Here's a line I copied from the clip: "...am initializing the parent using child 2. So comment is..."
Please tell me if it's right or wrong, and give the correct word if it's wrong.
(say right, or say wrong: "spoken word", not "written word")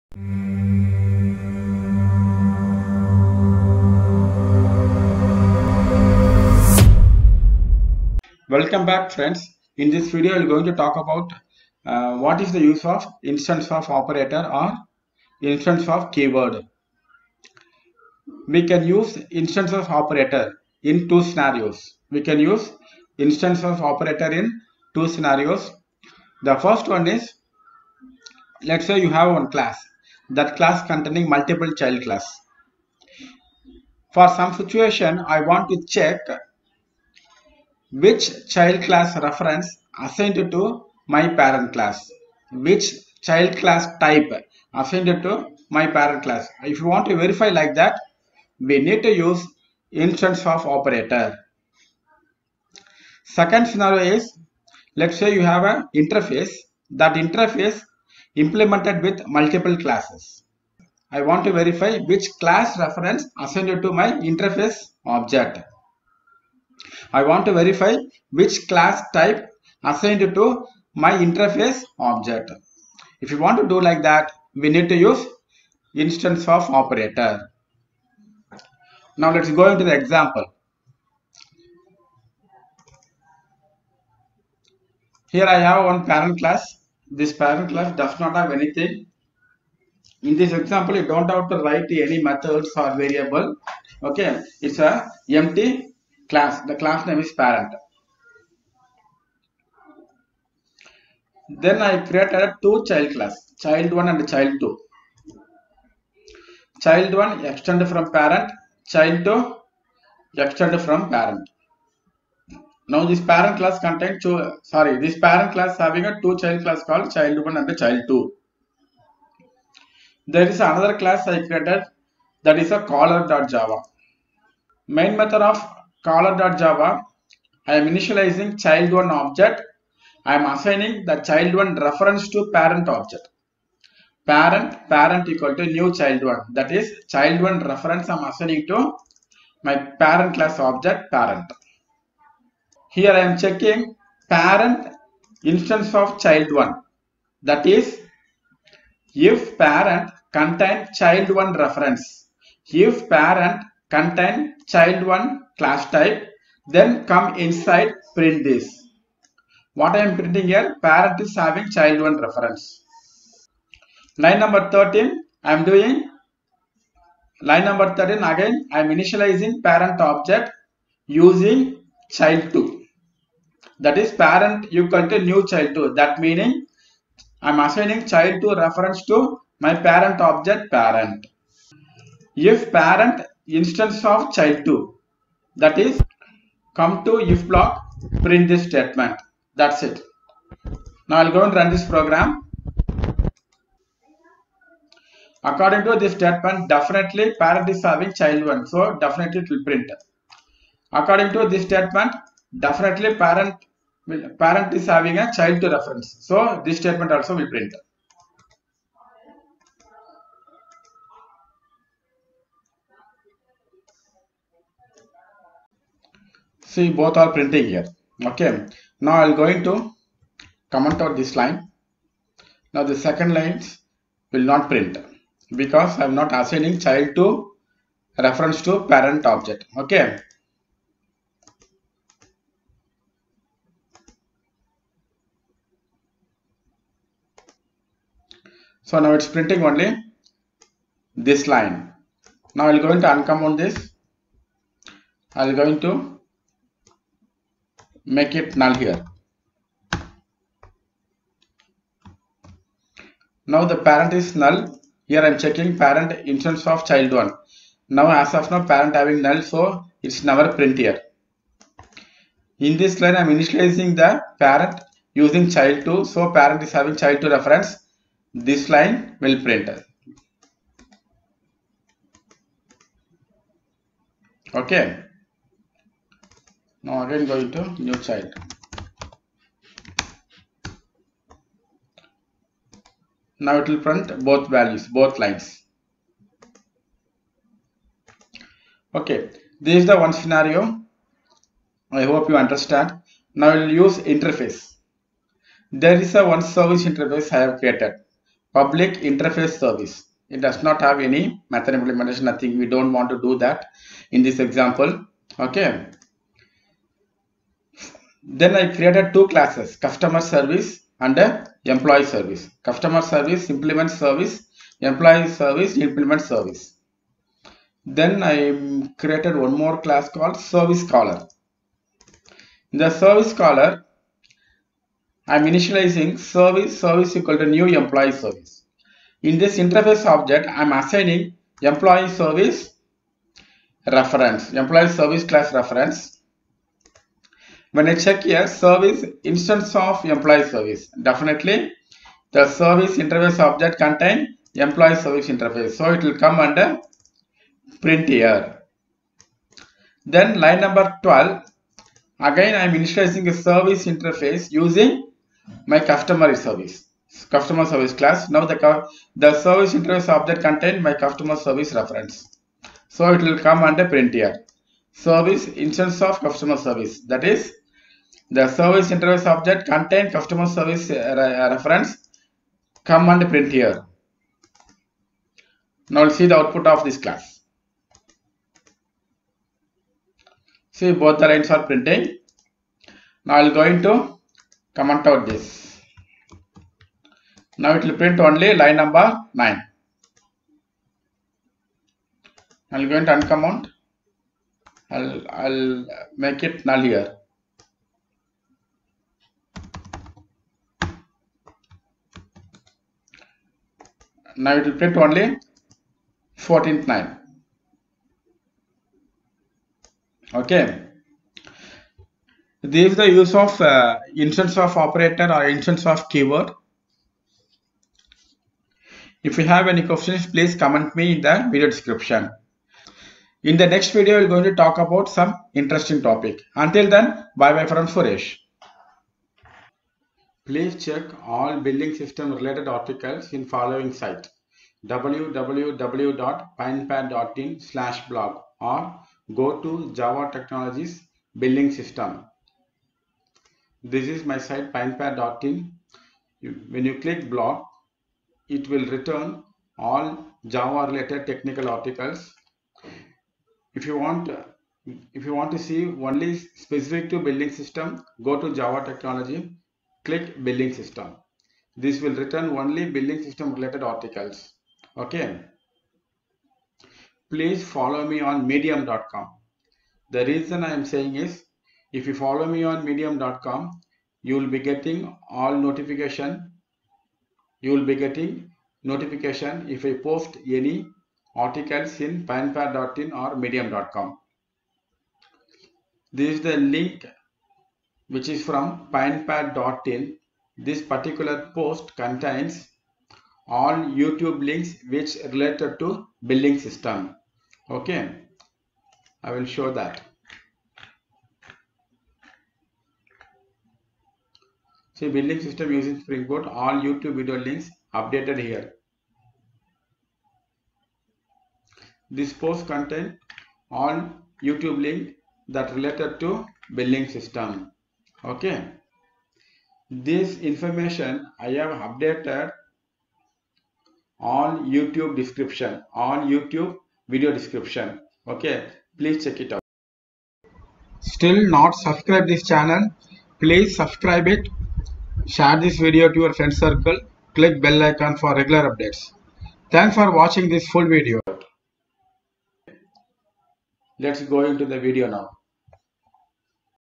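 wrong: "parent", not "comment".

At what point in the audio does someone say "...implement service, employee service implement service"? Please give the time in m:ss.
5:13.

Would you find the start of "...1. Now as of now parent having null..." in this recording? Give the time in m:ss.
4:17.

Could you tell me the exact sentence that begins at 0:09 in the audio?
In this video, we're going to talk about uh, what is the use of instance of operator or instance of keyword.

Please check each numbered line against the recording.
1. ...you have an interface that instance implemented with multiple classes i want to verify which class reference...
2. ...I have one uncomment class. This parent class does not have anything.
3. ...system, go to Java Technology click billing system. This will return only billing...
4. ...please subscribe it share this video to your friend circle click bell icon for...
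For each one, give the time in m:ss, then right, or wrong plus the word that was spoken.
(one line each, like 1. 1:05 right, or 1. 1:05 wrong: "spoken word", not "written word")
1. 0:55 wrong: "interface", not "instance"
2. 1:25 wrong: "parent", not "uncomment"
3. 7:37 right
4. 8:53 right.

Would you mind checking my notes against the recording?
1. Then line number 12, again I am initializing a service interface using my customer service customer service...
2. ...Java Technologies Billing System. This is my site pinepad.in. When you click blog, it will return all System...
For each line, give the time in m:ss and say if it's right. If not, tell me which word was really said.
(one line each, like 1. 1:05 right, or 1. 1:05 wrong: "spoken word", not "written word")
1. 5:50 right
2. 7:19 wrong: "Java", not "System".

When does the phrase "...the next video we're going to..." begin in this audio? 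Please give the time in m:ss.
7:03.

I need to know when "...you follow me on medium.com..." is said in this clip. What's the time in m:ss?
7:52.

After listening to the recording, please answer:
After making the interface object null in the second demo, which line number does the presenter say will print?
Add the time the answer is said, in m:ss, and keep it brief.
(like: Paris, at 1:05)
14, at 6:46.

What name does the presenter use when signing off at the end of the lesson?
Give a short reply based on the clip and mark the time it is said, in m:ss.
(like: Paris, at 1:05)
Suresh, at 7:07.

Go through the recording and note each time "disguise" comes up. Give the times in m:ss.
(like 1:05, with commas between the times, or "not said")
not said.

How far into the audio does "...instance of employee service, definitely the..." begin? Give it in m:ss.
5:39.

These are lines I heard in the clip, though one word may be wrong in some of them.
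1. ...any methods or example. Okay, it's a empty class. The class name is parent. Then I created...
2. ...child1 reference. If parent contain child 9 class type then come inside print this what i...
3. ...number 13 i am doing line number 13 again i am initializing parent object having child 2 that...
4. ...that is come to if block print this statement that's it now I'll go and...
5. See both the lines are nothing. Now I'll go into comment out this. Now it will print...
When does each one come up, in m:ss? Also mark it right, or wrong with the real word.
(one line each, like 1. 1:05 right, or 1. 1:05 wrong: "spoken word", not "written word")
1. 1:31 wrong: "variable", not "example"
2. 2:30 wrong: "1", not "9"
3. 2:44 wrong: "using", not "having"
4. 3:05 right
5. 6:20 wrong: "printing", not "nothing".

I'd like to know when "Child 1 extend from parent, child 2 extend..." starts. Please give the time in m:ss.
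1:46.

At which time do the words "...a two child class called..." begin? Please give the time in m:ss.
1:56.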